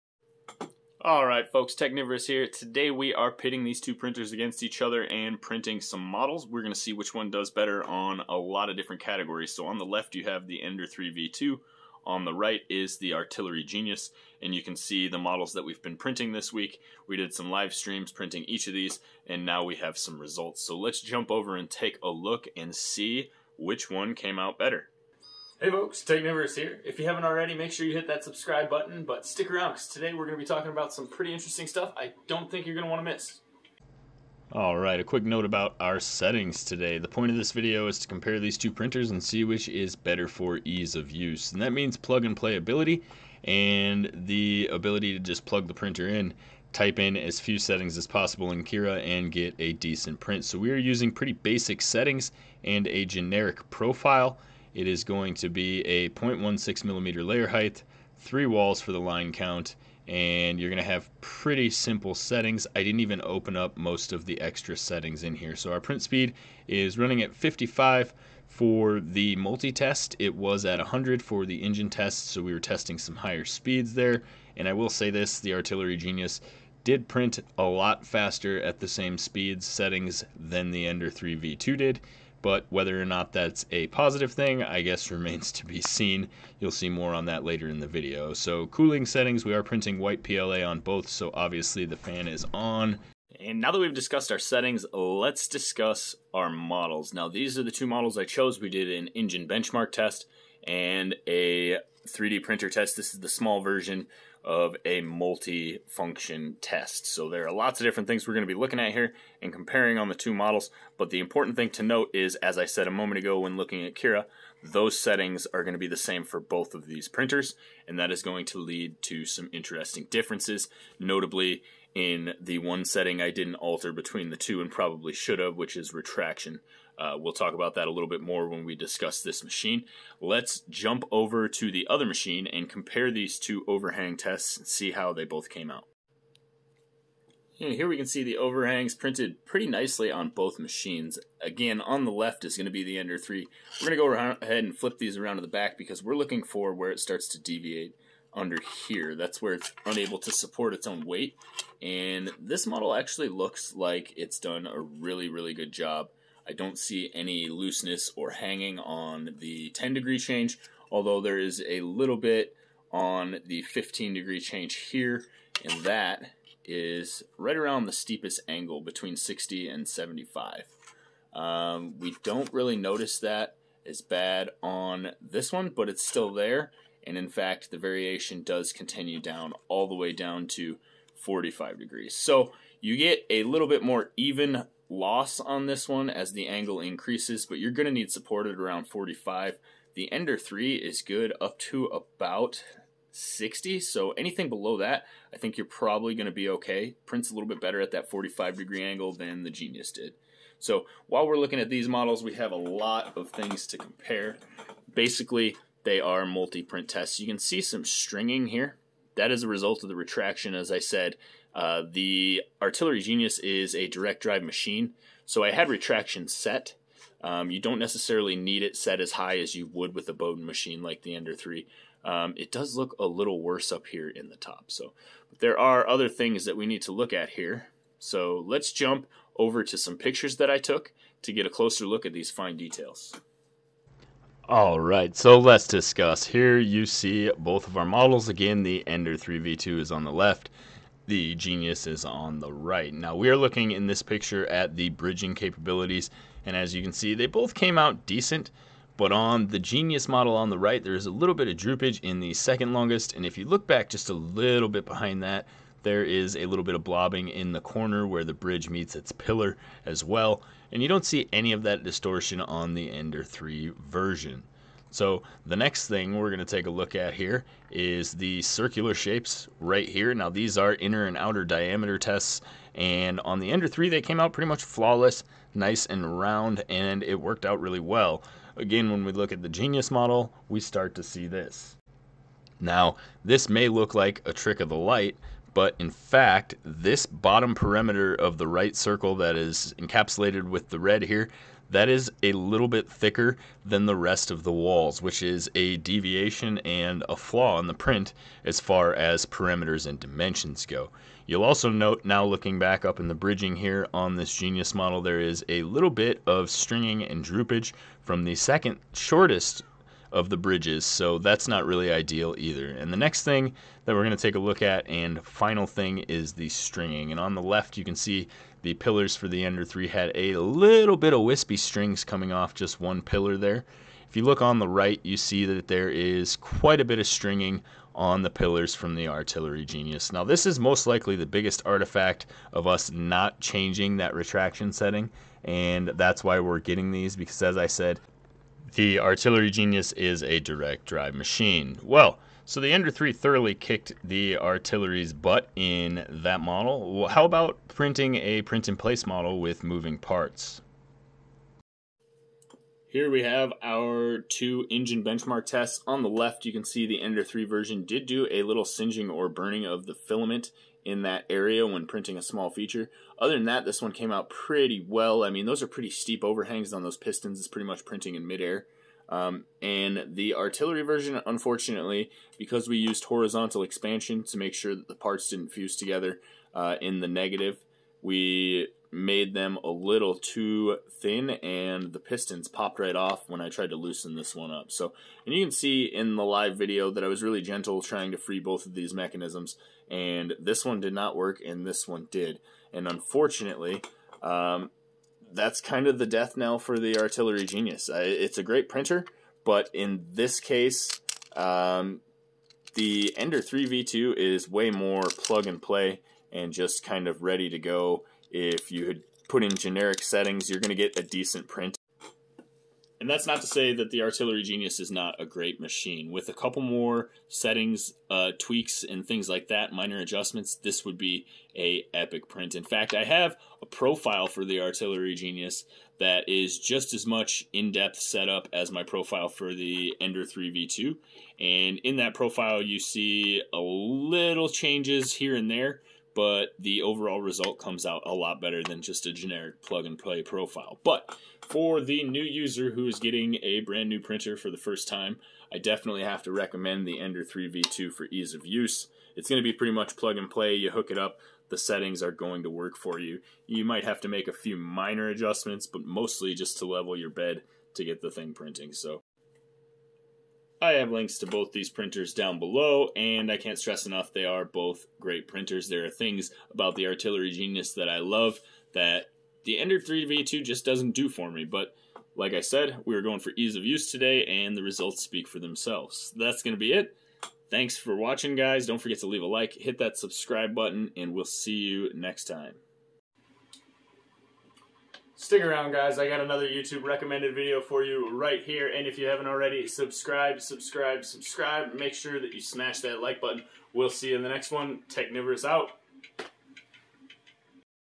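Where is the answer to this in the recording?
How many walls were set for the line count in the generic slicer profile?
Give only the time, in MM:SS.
00:58.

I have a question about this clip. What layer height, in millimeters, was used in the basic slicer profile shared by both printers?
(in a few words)
0.16.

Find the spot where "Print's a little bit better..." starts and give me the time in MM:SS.
03:17.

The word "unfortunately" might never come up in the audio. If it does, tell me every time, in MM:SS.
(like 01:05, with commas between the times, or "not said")
06:11, 06:32.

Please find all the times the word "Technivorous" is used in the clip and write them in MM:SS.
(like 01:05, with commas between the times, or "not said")
00:01, 00:26, 08:14.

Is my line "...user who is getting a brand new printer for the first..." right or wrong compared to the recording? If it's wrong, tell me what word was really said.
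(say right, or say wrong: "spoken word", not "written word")
right.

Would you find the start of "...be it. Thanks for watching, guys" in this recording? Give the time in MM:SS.
07:56.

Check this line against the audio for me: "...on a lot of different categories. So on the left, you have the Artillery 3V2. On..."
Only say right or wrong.
wrong.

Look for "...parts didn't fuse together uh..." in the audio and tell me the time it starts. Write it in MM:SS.
06:14.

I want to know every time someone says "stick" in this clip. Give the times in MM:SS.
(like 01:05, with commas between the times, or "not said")
00:29, 08:05.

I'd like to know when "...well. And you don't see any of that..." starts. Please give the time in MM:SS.
04:20.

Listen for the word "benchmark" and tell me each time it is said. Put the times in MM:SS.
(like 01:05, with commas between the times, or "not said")
01:39, 05:55.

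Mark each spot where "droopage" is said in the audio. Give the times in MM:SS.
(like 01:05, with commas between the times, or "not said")
04:11, 05:07.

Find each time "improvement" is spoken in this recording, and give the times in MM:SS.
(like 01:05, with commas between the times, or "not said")
not said.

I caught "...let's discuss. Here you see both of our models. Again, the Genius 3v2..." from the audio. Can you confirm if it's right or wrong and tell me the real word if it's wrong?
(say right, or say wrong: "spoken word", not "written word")
wrong: "Ender", not "Genius".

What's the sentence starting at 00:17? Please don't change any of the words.
We did some live streams printing each of these, and now we have some results.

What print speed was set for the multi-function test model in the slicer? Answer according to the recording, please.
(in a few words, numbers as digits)
55.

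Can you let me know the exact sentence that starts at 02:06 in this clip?
Uh, we'll talk about that a little bit more when we discuss this machine.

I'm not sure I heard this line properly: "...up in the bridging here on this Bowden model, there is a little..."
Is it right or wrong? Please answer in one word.
wrong.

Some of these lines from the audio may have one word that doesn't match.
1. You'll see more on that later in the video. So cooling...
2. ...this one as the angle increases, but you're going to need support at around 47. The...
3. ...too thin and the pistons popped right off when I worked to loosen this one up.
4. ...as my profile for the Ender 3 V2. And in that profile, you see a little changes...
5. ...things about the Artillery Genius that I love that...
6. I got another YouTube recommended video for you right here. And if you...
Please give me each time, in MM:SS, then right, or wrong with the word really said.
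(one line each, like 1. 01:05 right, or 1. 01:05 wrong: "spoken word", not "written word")
1. 01:26 right
2. 03:05 wrong: "45", not "47"
3. 06:20 wrong: "tried", not "worked"
4. 07:08 right
5. 07:45 right
6. 08:05 right.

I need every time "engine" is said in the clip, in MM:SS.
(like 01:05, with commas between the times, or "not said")
01:11, 01:39, 05:54.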